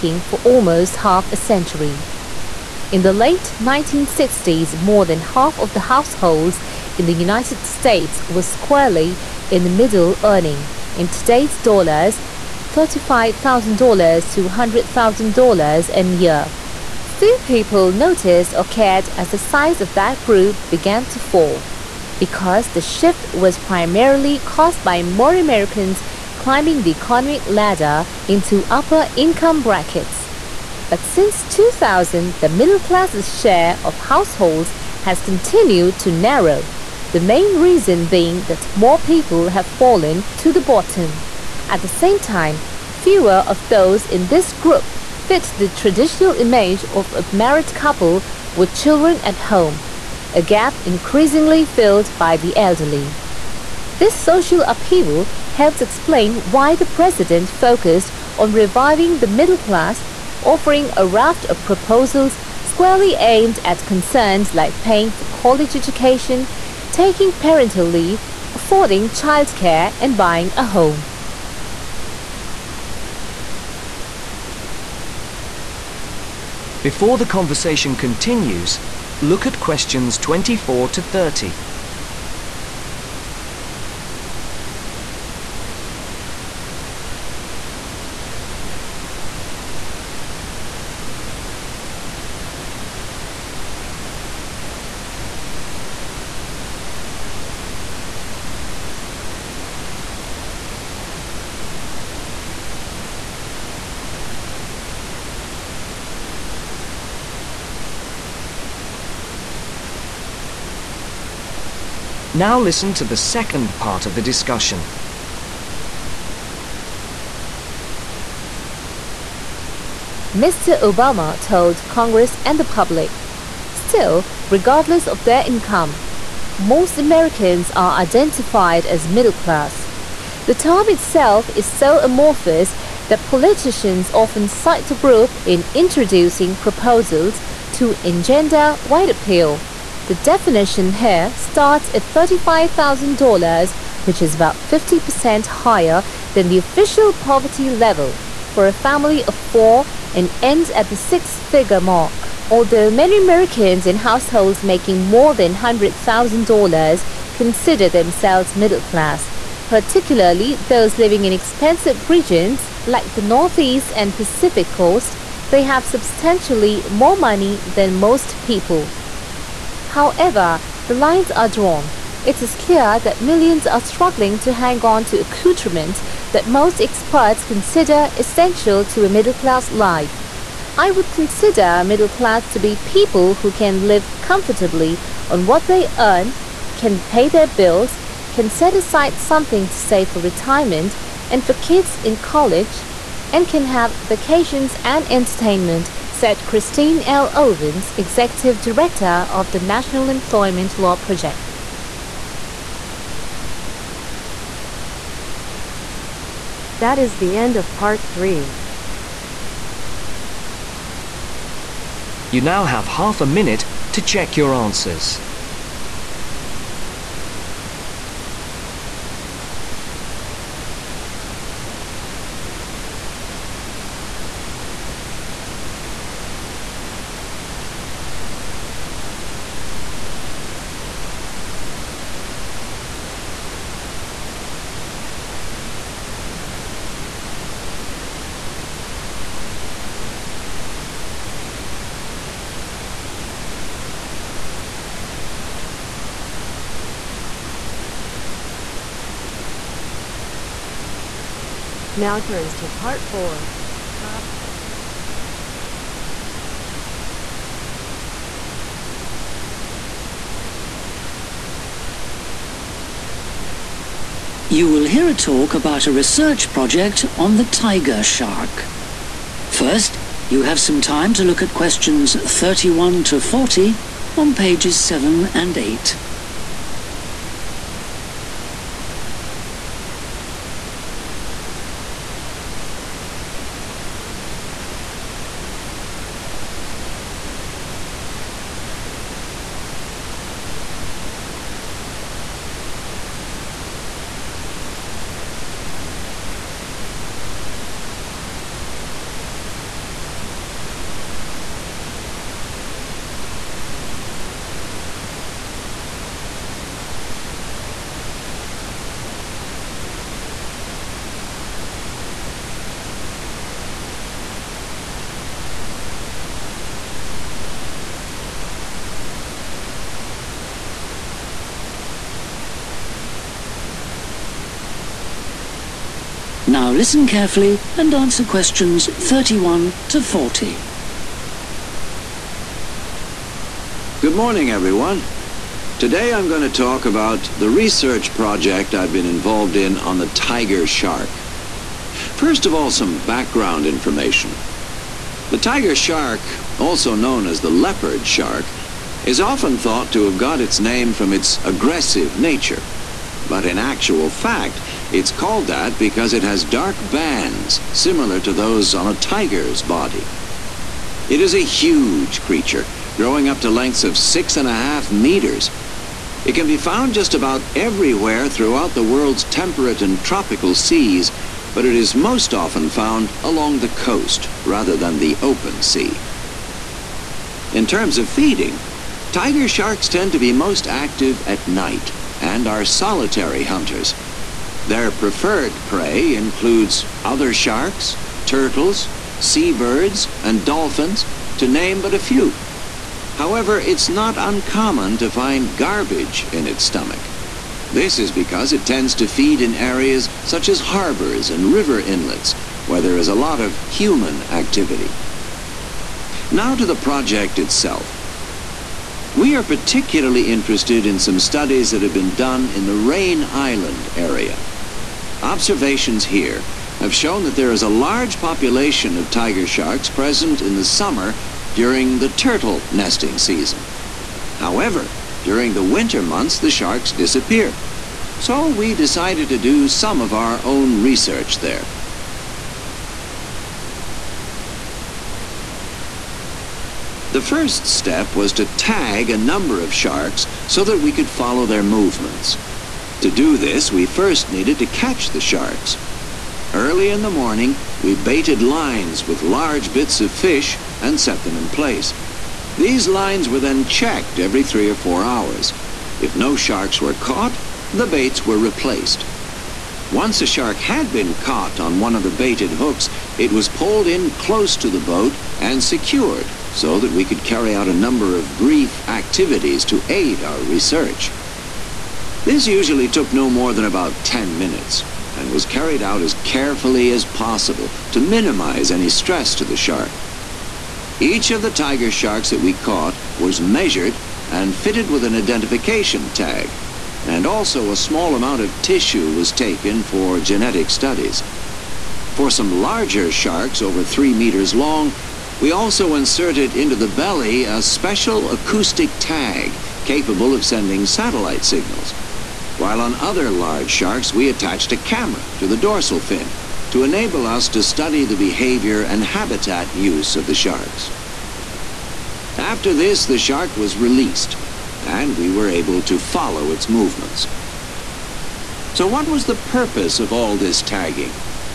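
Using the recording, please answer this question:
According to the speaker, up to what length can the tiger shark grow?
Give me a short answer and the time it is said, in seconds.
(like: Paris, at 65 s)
6.5 meters, at 363 s.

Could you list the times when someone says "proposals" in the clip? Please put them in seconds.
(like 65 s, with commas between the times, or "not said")
61 s, 136 s.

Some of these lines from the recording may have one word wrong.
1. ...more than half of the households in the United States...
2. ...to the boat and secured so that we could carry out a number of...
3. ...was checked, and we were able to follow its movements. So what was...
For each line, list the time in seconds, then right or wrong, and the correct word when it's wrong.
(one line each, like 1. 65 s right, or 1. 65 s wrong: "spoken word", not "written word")
1. 4 s right
2. 464 s right
3. 513 s wrong: "released", not "checked".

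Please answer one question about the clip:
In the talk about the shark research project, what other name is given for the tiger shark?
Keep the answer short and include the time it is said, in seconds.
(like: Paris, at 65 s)
leopard shark, at 347 s.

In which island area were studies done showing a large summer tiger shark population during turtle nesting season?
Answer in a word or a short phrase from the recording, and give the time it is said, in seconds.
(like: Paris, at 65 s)
Raine Island, at 412 s.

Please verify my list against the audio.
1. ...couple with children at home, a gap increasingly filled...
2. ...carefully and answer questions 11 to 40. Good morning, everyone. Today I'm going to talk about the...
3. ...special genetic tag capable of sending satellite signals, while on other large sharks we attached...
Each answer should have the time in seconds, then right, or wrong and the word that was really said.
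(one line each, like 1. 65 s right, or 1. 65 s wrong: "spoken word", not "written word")
1. 47 s right
2. 327 s wrong: "31", not "11"
3. 497 s wrong: "acoustic", not "genetic".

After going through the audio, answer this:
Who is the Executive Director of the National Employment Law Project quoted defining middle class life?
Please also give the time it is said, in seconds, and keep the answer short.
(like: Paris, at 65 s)
Christine L. Owens, at 196 s.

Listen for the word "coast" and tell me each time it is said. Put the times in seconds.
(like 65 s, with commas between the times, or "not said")
164 s, 373 s.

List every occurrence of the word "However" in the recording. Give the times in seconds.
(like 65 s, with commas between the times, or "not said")
169 s, 393 s, 424 s.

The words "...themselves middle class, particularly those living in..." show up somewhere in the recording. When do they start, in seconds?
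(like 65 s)
157 s.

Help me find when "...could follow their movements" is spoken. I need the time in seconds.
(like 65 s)
440 s.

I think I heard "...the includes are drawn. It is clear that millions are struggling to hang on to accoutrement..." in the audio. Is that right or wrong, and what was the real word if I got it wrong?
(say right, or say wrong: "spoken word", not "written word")
wrong: "lines", not "includes".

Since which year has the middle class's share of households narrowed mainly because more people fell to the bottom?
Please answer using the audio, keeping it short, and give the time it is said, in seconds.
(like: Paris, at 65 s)
2000, at 31 s.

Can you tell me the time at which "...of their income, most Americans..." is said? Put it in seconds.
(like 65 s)
125 s.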